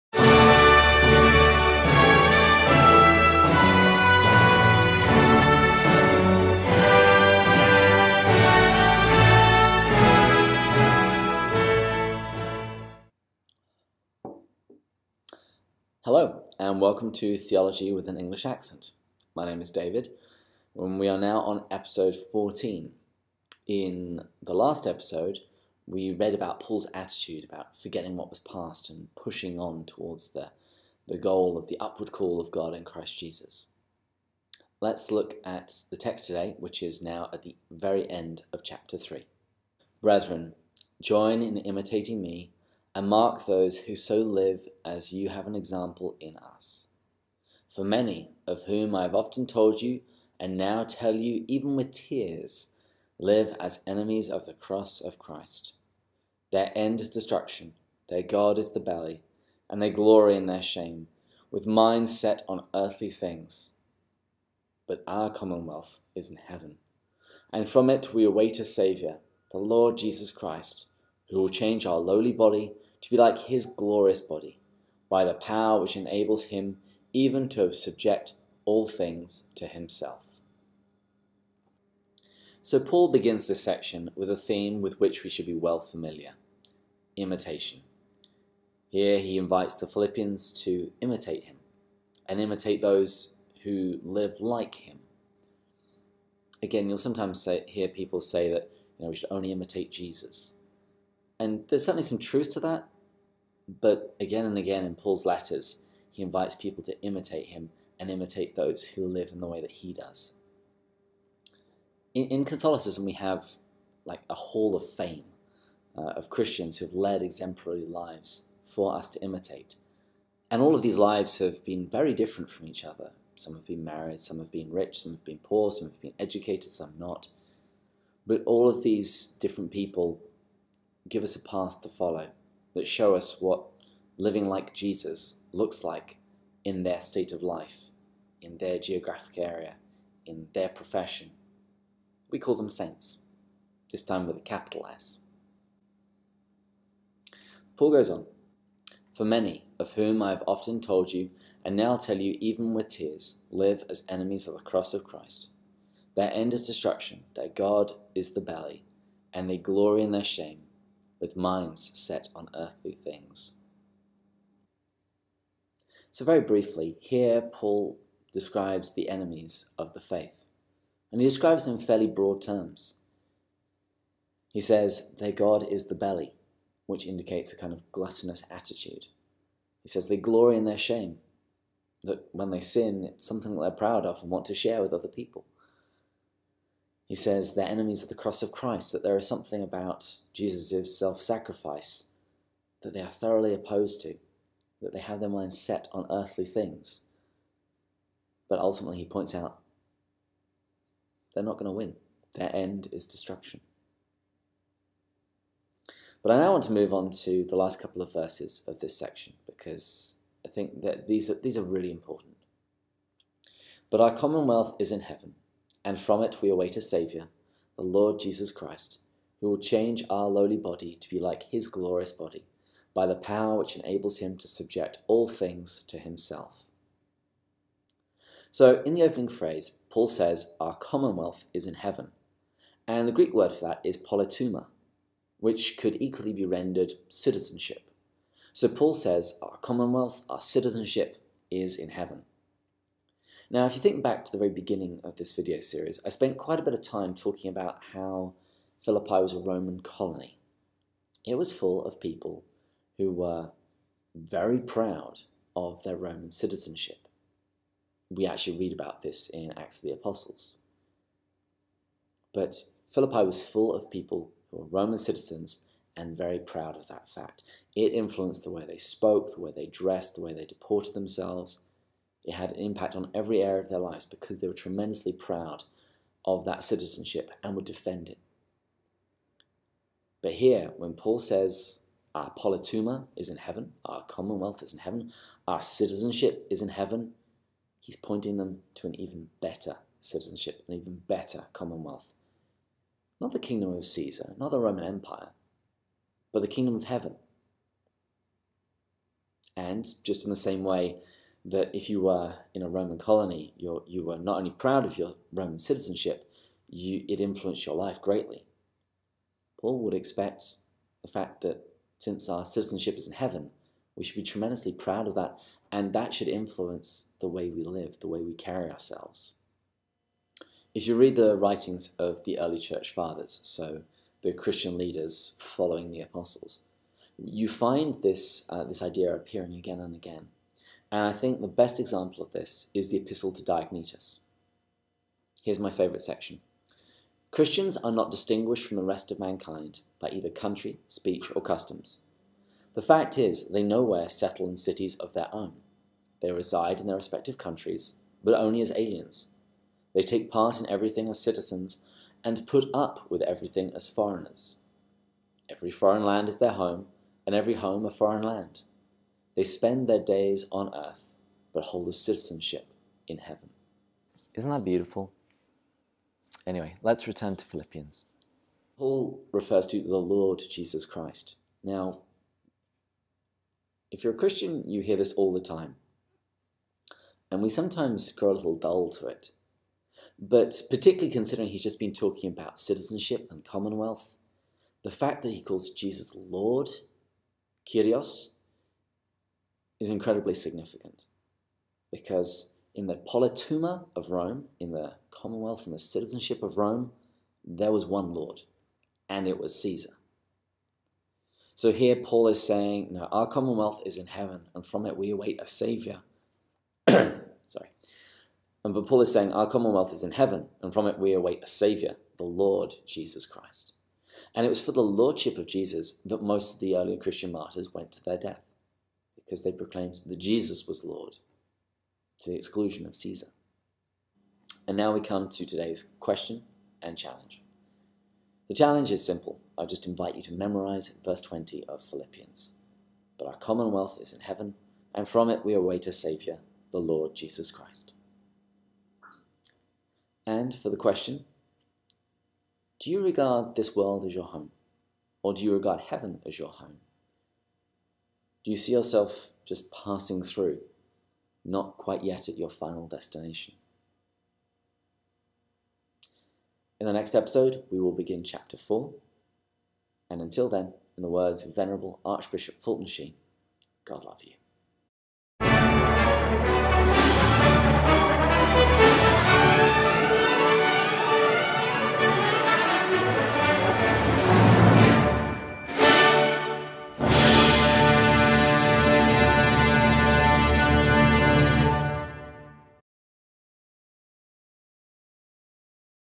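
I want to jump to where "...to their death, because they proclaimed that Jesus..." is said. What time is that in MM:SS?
06:57.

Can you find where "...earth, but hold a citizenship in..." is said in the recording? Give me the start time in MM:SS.
06:00.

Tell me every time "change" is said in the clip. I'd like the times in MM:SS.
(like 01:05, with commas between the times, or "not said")
01:11, 03:39.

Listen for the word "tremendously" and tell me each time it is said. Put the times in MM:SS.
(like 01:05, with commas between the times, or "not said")
04:34, 05:14.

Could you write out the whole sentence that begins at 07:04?
And now we come to today's question and challenge.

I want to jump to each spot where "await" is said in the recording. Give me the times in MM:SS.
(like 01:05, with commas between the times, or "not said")
01:08, 03:36, 06:45, 06:51, 07:15.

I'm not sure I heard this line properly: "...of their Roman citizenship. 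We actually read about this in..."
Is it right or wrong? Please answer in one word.
right.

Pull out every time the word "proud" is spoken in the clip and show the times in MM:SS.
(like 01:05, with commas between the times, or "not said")
03:03, 04:14, 04:26, 04:35, 05:04, 05:14.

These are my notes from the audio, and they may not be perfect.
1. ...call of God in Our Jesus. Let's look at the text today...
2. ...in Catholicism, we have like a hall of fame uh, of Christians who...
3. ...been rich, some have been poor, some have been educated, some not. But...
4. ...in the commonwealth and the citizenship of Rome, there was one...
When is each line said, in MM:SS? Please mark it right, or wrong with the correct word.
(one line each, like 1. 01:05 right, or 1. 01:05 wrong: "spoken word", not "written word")
1. 00:32 wrong: "Christ", not "Our"
2. 01:52 right
3. 02:04 right
4. 06:34 right.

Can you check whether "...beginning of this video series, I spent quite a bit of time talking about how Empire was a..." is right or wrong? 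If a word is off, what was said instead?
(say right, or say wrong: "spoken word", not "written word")
wrong: "Philippi", not "Empire".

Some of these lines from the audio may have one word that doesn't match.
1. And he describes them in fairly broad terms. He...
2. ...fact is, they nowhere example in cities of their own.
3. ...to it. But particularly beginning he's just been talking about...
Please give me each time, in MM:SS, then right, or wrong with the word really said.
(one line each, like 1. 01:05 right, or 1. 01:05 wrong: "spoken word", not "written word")
1. 02:51 right
2. 05:42 wrong: "settle", not "example"
3. 06:18 wrong: "considering", not "beginning".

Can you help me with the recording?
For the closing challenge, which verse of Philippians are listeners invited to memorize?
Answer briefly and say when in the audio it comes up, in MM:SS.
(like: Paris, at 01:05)
verse 20, at 07:11.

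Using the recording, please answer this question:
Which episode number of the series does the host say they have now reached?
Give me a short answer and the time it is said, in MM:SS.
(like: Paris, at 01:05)
14, at 00:21.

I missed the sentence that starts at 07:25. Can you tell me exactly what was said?
Or do you regard heaven as your home?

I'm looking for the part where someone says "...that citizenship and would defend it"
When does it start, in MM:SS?
04:36.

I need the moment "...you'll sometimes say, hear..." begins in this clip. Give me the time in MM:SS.
01:36.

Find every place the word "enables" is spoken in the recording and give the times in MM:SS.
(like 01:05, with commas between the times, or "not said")
01:15, 03:43.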